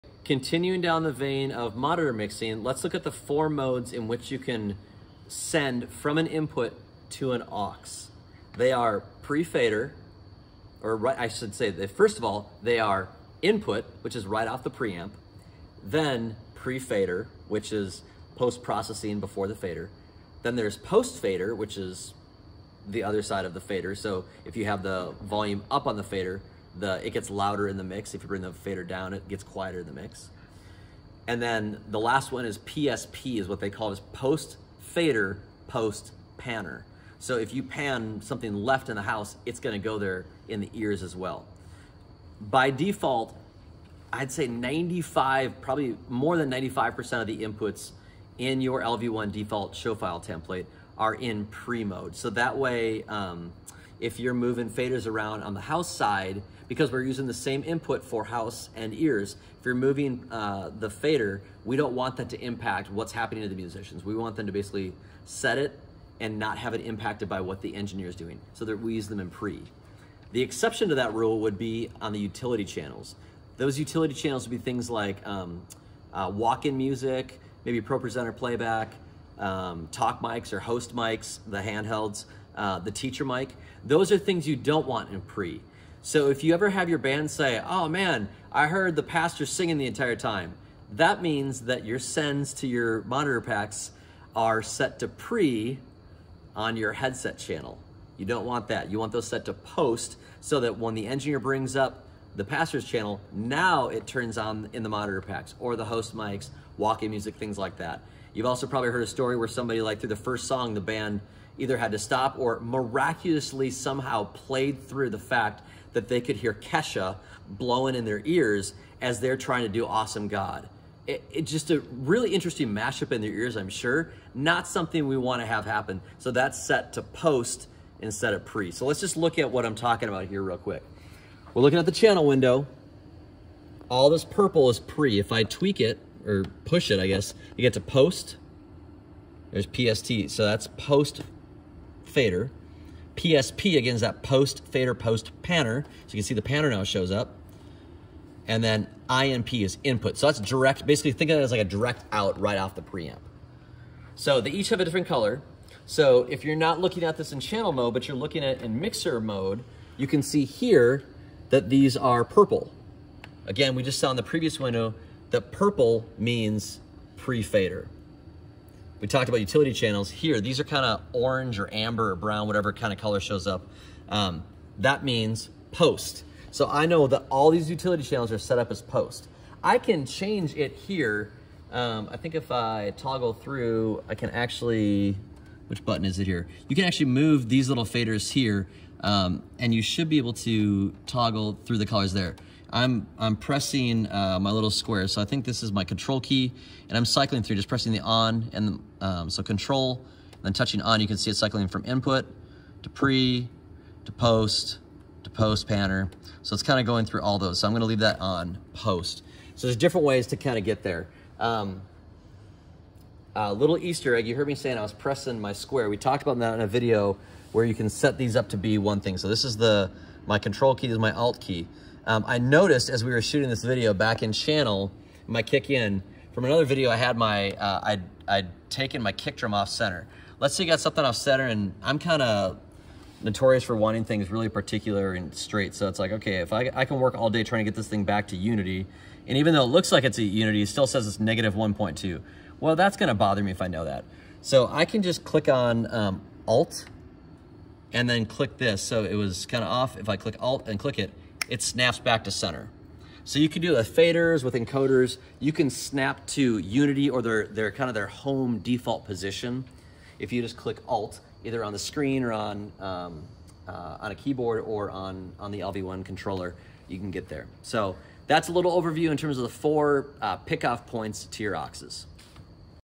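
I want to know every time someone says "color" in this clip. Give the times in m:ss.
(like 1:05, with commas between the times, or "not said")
2:35, 2:52, 3:11.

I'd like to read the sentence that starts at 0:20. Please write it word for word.
Then there's post-fader, which is the other side of the fader.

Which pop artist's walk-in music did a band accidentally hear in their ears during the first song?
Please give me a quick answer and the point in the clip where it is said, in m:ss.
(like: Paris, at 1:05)
Kesha, at 1:56.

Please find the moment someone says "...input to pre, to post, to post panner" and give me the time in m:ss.
3:21.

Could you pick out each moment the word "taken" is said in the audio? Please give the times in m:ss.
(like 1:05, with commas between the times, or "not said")
3:48.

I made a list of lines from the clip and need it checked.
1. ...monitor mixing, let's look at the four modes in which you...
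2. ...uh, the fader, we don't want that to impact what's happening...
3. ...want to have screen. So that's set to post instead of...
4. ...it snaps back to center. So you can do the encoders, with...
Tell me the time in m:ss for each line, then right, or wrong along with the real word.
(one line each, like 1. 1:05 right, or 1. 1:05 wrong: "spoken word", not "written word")
1. 0:01 right
2. 1:00 right
3. 2:05 wrong: "happen", not "screen"
4. 4:11 wrong: "faders", not "encoders".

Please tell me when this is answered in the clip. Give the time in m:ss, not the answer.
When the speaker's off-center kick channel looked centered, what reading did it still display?
4:01.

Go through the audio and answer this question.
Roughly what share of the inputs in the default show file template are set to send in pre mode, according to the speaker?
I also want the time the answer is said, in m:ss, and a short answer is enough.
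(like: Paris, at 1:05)
more than 95%, at 0:46.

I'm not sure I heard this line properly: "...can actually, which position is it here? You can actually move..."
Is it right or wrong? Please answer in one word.
wrong.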